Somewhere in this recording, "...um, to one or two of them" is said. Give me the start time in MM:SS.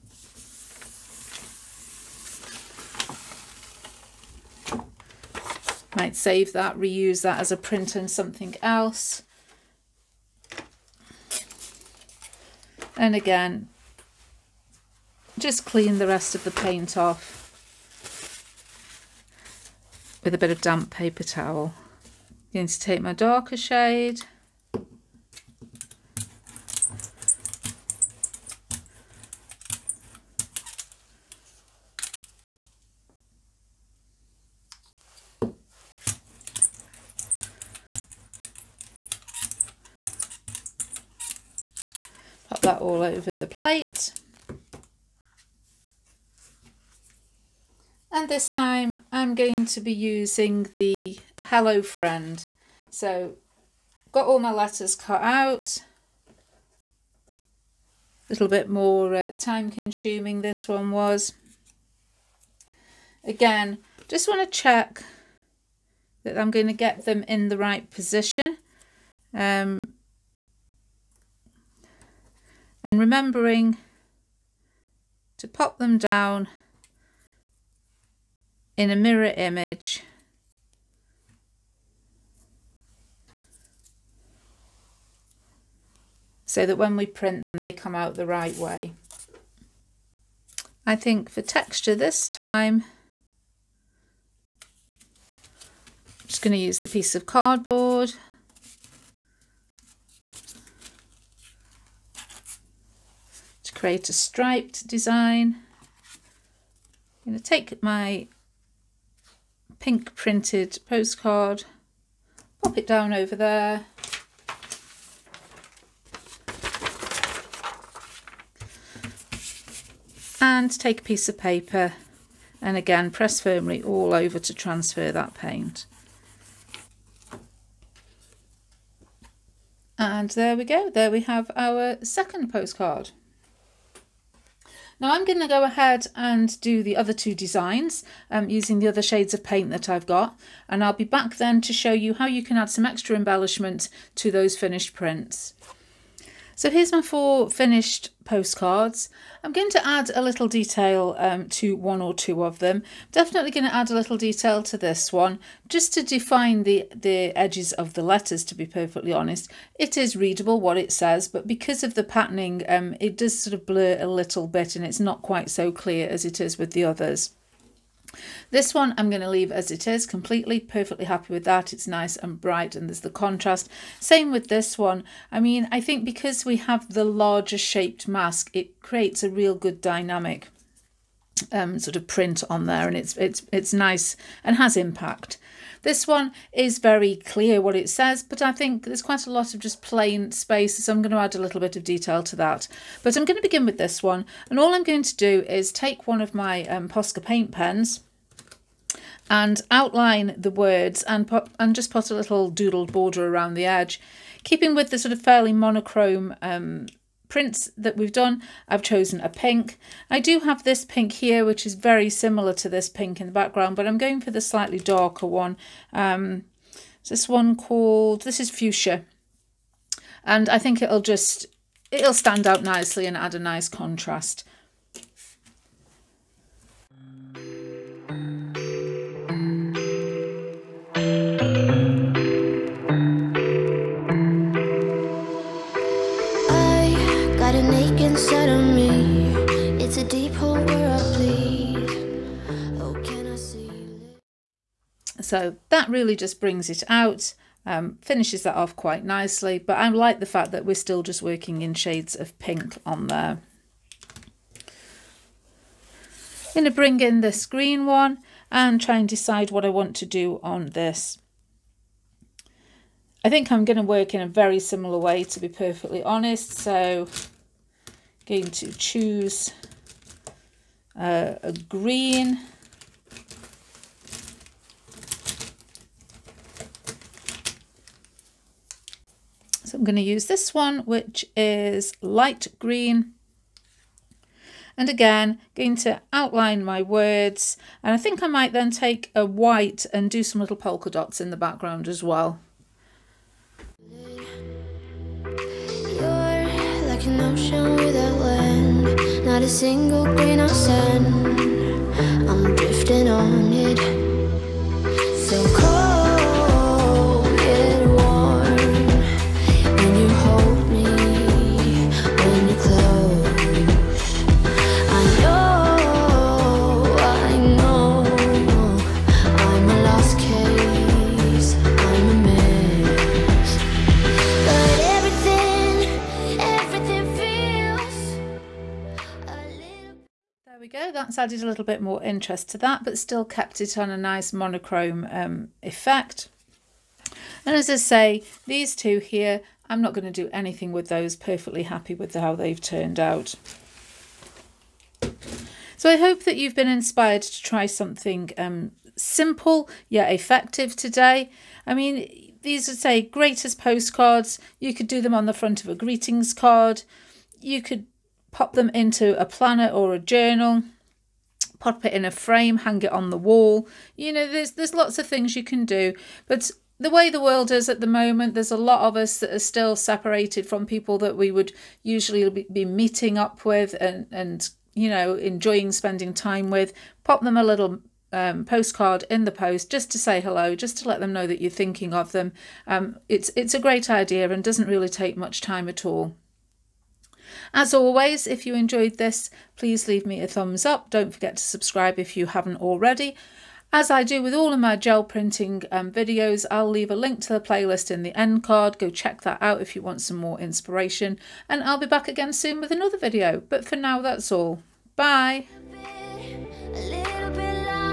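02:31.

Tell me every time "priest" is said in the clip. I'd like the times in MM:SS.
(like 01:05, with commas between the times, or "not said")
not said.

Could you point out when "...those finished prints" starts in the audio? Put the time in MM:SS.
02:24.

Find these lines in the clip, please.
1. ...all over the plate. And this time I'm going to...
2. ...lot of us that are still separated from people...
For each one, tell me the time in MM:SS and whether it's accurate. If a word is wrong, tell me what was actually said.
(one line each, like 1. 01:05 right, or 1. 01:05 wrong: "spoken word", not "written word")
1. 00:42 right
2. 06:08 right.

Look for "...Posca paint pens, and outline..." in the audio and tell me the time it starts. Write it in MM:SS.
03:16.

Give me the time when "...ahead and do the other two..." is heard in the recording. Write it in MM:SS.
02:15.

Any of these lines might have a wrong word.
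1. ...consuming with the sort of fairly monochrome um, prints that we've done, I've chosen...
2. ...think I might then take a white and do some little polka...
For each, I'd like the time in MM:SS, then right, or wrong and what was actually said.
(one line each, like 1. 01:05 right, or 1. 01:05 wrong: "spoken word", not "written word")
1. 03:24 wrong: "keeping", not "consuming"
2. 04:47 right.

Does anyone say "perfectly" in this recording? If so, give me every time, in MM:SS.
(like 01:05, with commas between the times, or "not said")
02:38, 02:50, 04:25, 05:41.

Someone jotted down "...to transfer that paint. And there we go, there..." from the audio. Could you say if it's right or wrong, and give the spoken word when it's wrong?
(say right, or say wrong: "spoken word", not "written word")
right.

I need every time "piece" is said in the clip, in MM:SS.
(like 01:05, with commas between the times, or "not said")
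01:36, 02:01.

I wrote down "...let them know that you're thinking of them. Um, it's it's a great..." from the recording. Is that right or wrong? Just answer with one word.
right.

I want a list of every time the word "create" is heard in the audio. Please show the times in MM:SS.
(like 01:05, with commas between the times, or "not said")
01:43, 02:58.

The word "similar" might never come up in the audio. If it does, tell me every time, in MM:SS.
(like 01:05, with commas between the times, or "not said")
03:32, 04:24.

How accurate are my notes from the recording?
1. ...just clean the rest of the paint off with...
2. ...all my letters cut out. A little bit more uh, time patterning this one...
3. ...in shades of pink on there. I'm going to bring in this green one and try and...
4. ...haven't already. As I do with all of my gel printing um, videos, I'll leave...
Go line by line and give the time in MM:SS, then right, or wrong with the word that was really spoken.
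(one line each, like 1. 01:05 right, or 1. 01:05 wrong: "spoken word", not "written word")
1. 00:15 right
2. 00:54 wrong: "consuming", not "patterning"
3. 04:11 right
4. 06:32 right.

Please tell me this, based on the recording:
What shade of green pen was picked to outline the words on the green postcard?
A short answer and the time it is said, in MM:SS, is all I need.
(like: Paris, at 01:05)
light green, at 04:42.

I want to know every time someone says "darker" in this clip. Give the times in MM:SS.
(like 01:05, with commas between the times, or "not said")
00:23, 03:34.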